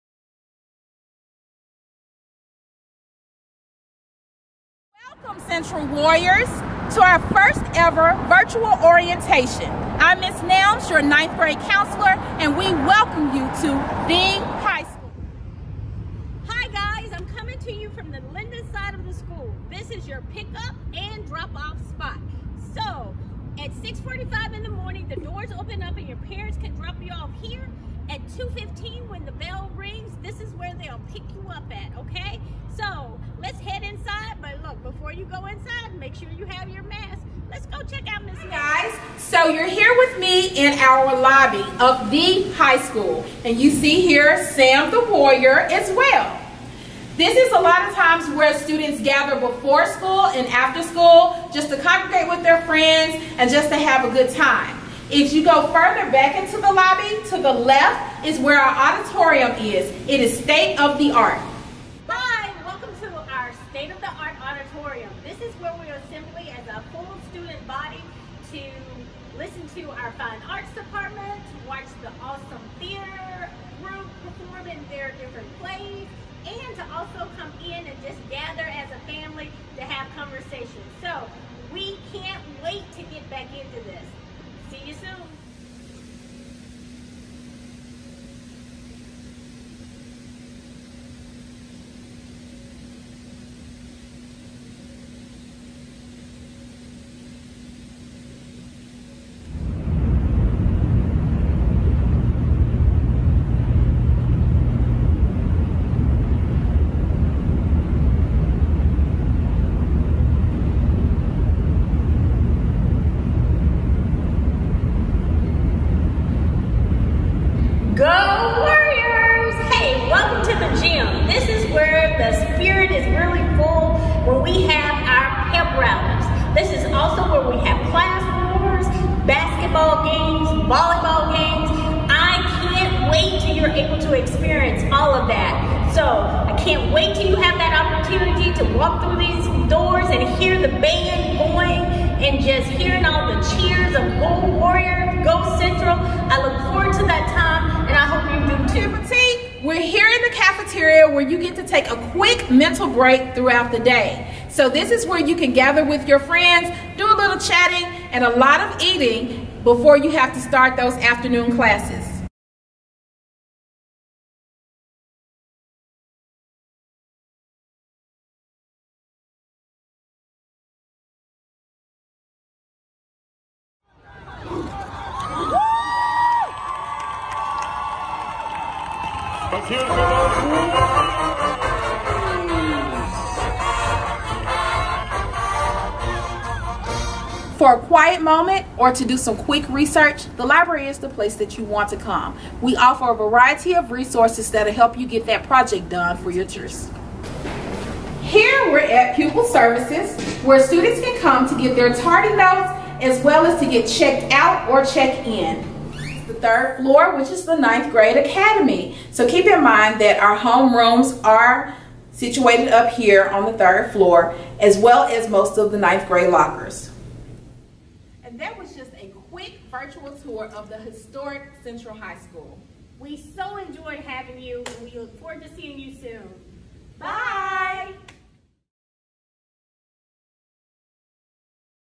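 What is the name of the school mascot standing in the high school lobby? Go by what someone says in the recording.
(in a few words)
Sam the Warrior.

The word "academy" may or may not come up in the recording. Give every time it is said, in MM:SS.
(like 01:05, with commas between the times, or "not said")
03:28.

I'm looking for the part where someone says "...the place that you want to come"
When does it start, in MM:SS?
03:10.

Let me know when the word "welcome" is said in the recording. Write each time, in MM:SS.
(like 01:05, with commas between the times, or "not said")
00:05, 00:12, 01:02.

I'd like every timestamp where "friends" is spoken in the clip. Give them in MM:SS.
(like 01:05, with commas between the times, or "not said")
00:52, 02:36.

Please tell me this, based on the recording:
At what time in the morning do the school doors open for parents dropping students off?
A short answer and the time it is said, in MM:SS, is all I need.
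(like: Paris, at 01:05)
6:45, at 00:23.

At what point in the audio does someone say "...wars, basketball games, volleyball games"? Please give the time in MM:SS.
02:08.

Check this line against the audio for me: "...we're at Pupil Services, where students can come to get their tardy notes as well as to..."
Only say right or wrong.
right.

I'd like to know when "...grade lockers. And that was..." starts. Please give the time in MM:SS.
03:36.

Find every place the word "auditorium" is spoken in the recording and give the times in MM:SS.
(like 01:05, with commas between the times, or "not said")
00:58, 01:04.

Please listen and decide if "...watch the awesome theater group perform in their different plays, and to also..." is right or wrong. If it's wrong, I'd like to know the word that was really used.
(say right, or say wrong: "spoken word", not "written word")
right.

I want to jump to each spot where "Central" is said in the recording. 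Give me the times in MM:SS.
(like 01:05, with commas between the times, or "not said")
00:05, 03:41.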